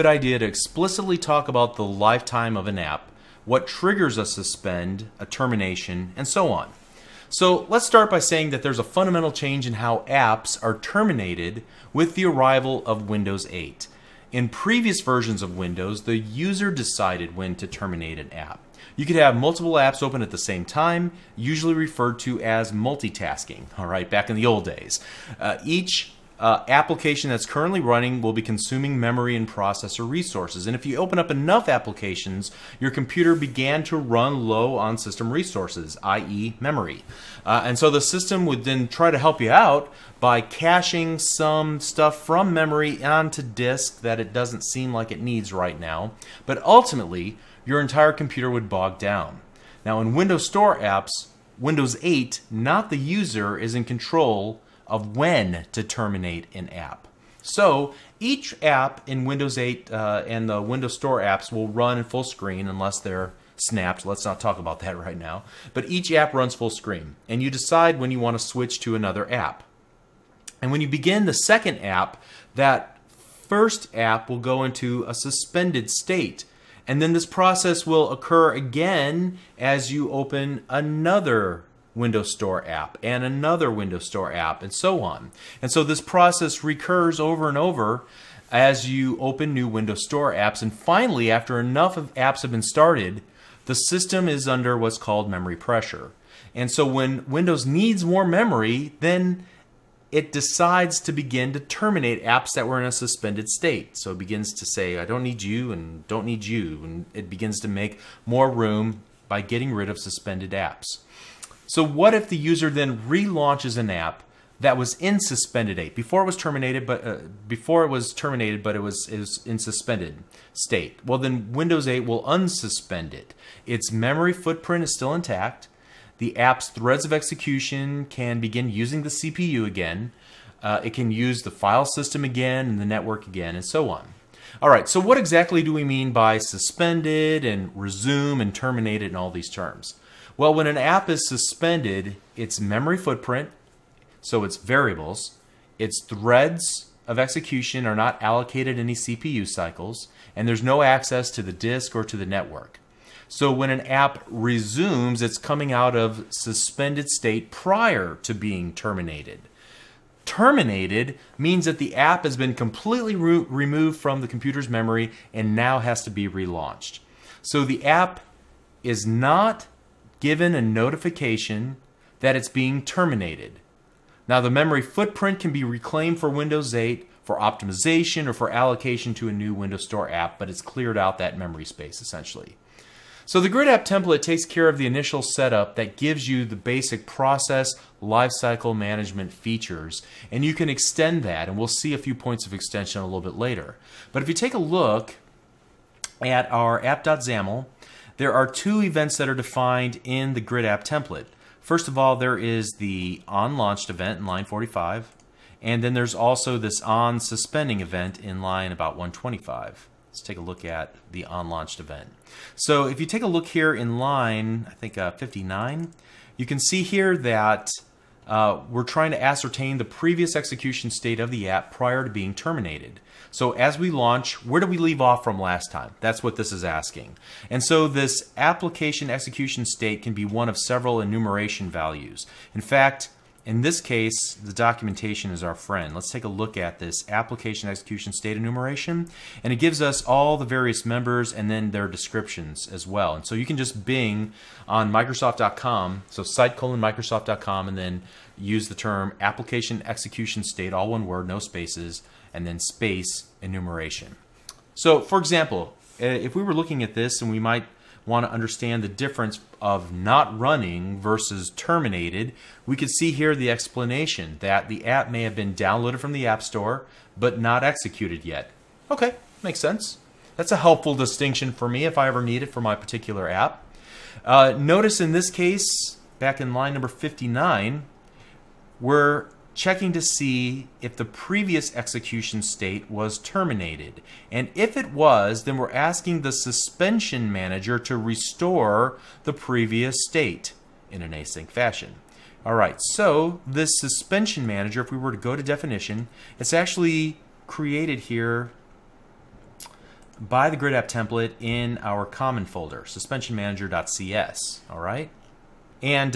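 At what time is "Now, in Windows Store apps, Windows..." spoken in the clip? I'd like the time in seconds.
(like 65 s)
49 s.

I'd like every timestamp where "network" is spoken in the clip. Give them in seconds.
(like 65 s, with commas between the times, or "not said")
132 s, 152 s.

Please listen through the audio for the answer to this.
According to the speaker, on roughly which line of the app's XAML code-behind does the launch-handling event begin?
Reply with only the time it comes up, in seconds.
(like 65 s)
204 s.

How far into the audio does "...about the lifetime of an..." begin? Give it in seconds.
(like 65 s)
1 s.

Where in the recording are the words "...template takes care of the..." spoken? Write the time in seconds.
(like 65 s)
183 s.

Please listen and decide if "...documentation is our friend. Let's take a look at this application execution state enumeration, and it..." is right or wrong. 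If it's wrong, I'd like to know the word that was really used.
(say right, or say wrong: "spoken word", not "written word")
right.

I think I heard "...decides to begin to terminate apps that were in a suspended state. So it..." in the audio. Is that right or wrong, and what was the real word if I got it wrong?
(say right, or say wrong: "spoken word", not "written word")
right.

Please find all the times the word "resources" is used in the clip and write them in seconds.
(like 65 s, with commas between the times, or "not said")
30 s, 35 s.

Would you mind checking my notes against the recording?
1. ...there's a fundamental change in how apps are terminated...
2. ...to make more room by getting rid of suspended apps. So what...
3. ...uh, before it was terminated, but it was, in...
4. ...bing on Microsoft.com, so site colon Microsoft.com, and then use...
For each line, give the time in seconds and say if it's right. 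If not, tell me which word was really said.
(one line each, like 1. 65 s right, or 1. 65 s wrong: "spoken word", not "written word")
1. 8 s right
2. 107 s right
3. 117 s right
4. 243 s right.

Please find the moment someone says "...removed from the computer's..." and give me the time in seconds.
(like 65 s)
163 s.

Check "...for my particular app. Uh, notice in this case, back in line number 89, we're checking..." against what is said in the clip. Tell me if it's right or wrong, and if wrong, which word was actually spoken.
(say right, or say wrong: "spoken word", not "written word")
wrong: "59", not "89".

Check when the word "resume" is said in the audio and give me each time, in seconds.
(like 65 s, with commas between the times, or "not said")
137 s, 154 s.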